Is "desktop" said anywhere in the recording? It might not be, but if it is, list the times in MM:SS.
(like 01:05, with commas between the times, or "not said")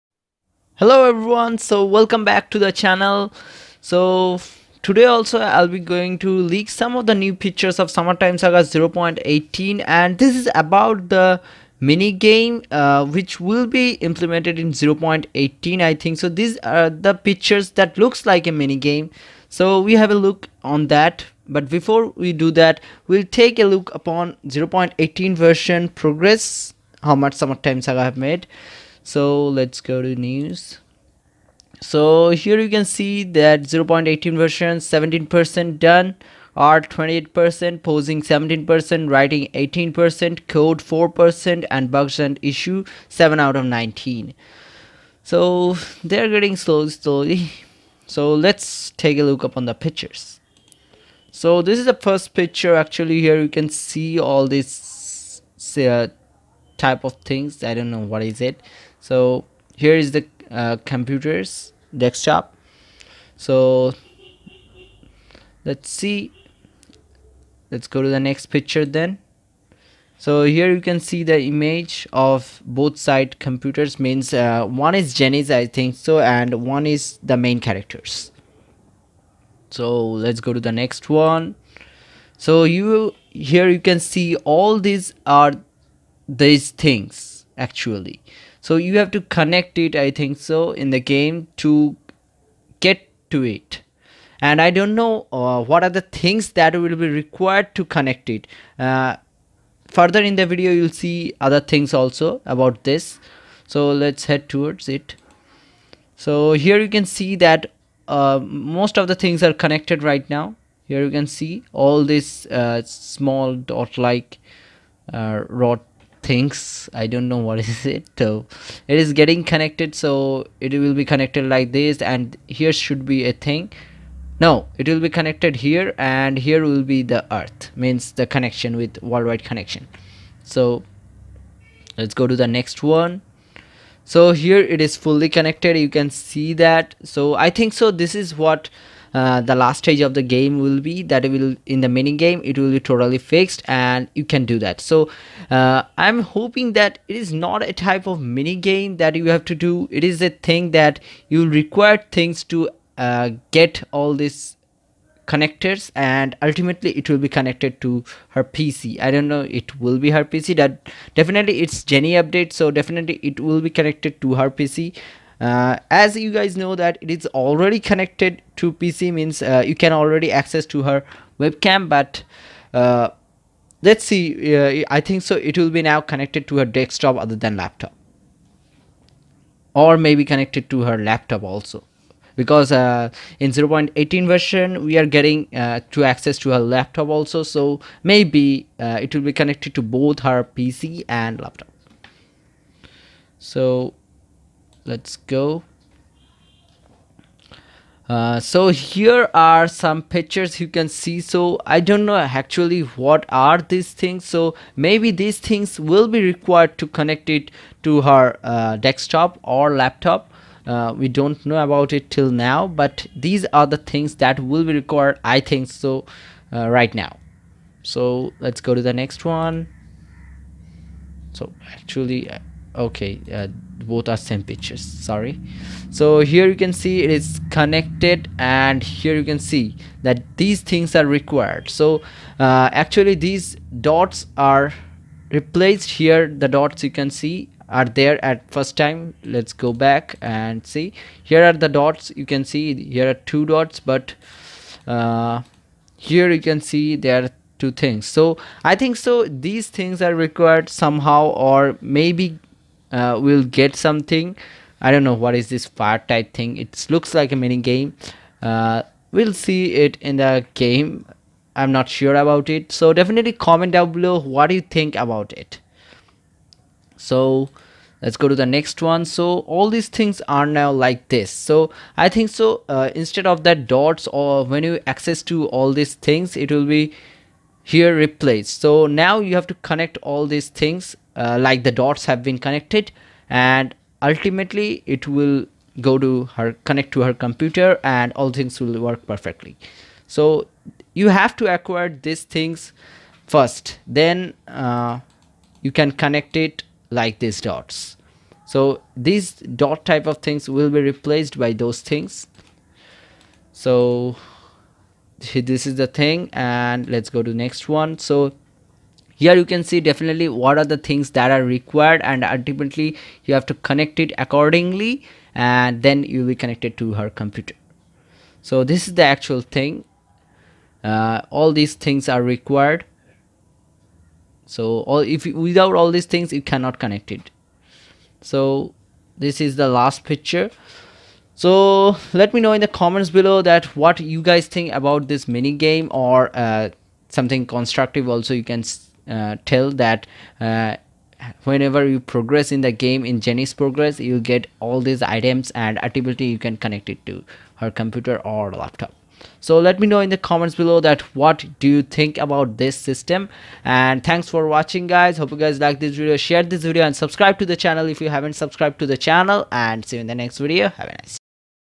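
01:01, 02:56, 03:28.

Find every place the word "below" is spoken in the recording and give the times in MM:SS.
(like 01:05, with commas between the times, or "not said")
04:23, 05:33, 05:50.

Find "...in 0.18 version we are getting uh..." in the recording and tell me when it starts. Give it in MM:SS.
03:03.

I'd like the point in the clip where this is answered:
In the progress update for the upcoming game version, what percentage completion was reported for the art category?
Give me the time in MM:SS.
00:36.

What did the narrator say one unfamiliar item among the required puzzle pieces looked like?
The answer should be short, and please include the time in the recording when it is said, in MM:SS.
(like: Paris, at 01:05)
fire, at 04:15.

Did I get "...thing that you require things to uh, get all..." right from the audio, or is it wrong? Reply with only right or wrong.
right.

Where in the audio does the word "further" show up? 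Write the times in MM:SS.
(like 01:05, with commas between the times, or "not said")
01:39.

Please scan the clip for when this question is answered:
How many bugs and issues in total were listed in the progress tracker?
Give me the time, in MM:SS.
00:43.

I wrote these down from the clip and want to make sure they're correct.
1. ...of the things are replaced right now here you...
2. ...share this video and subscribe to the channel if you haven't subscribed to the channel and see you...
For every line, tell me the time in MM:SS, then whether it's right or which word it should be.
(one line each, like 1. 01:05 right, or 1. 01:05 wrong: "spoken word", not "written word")
1. 01:48 wrong: "connected", not "replaced"
2. 05:56 right.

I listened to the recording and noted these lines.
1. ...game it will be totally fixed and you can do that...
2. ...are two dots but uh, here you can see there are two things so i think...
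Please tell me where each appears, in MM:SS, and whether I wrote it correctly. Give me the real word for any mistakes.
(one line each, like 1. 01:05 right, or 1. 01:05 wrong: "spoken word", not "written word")
1. 02:22 right
2. 04:03 right.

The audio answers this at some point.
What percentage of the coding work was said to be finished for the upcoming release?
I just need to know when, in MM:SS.
00:40.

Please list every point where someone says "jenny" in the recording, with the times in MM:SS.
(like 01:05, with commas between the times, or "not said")
01:15, 02:41, 05:43.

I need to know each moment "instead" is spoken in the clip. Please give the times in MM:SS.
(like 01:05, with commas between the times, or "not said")
04:32.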